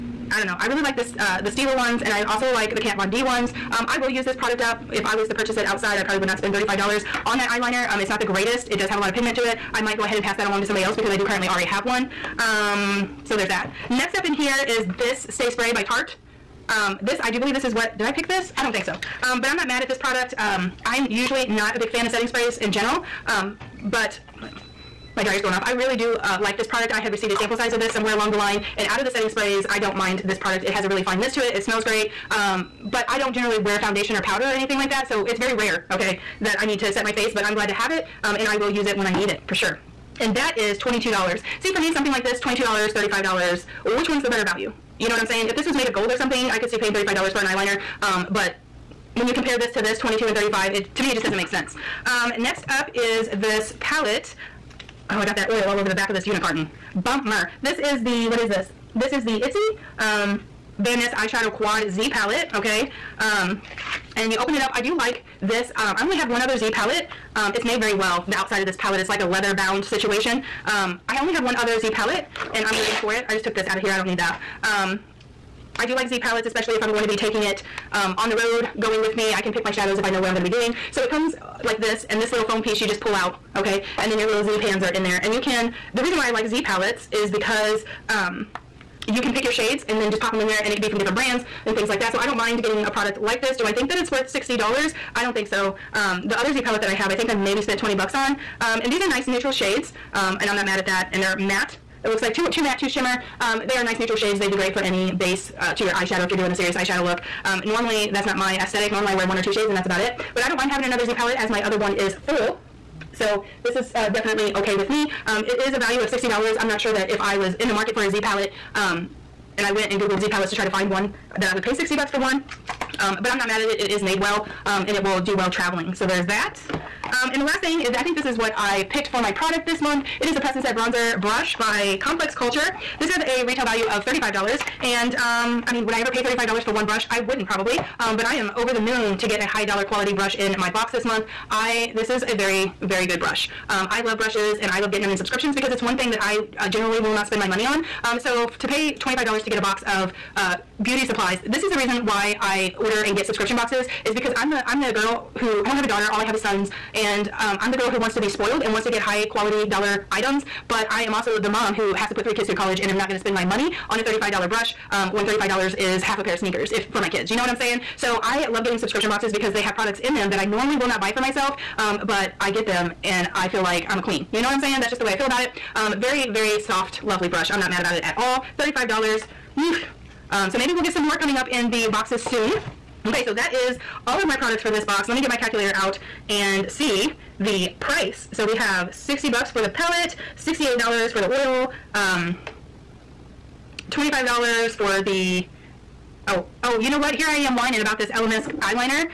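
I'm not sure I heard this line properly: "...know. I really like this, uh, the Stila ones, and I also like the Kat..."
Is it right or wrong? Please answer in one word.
right.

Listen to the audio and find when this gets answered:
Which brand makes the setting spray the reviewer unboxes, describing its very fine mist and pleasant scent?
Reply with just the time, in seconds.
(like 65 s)
15 s.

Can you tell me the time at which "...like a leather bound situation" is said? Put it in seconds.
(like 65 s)
69 s.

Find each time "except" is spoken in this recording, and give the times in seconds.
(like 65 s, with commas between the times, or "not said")
not said.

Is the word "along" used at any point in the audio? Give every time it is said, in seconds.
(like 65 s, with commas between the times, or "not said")
10 s, 28 s.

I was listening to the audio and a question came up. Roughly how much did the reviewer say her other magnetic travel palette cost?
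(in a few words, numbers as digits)
$20.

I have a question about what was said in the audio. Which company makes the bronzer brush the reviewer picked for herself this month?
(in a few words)
Complex Culture.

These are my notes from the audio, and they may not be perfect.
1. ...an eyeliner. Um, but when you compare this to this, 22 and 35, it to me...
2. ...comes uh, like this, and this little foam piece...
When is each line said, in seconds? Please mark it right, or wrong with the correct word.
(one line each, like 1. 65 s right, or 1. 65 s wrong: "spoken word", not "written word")
1. 47 s right
2. 81 s right.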